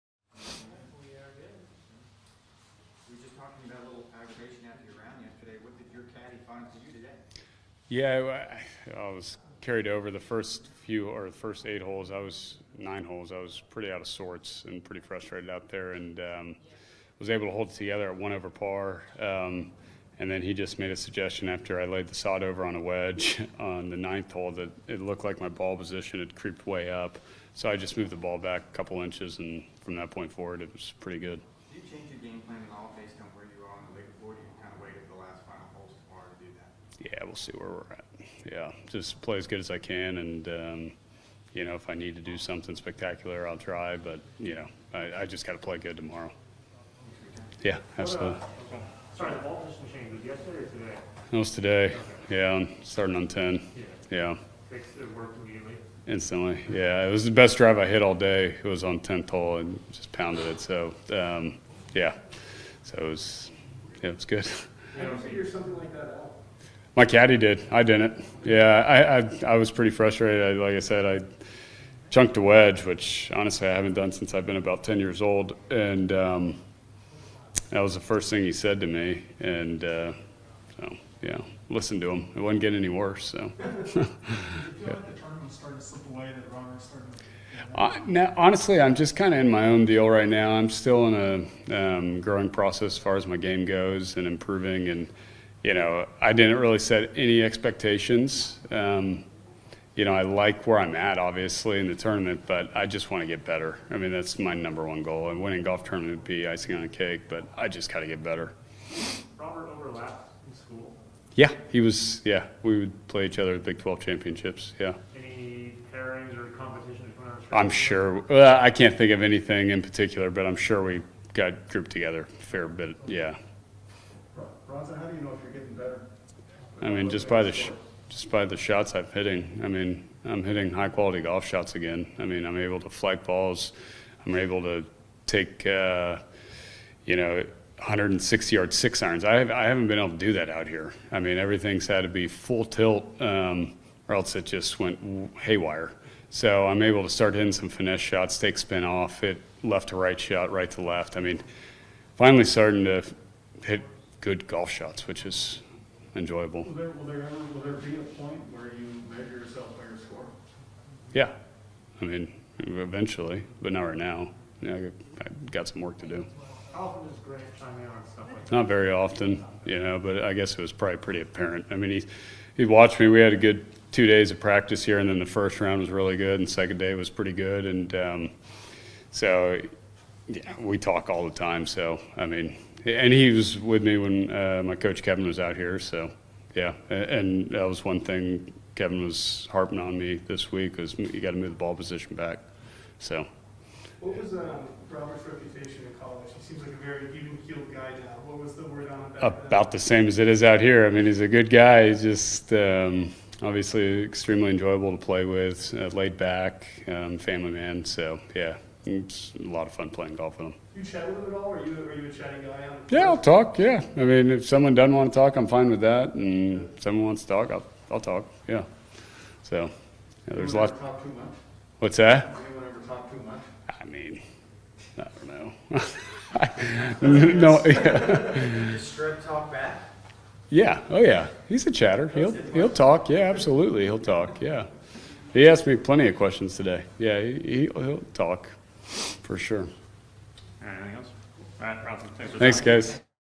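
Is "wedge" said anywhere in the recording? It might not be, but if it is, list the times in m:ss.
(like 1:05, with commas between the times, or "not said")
0:22, 1:12.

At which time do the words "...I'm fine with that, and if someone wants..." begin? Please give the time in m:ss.
3:35.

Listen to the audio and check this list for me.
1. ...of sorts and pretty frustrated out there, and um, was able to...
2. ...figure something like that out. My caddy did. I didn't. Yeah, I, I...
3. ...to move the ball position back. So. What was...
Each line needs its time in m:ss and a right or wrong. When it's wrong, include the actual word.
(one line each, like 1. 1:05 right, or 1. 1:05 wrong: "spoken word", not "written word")
1. 0:14 right
2. 1:05 right
3. 3:11 right.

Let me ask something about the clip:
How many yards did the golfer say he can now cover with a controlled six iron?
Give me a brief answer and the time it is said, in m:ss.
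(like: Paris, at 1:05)
160, at 2:17.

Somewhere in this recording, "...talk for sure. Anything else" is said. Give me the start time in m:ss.
3:58.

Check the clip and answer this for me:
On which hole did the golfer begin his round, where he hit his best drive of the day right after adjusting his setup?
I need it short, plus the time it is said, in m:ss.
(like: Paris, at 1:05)
10, at 0:53.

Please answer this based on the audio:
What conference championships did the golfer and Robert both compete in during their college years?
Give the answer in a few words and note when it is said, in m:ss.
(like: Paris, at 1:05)
Big 12, at 1:53.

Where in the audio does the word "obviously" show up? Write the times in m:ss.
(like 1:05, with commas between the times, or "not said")
1:41, 3:23.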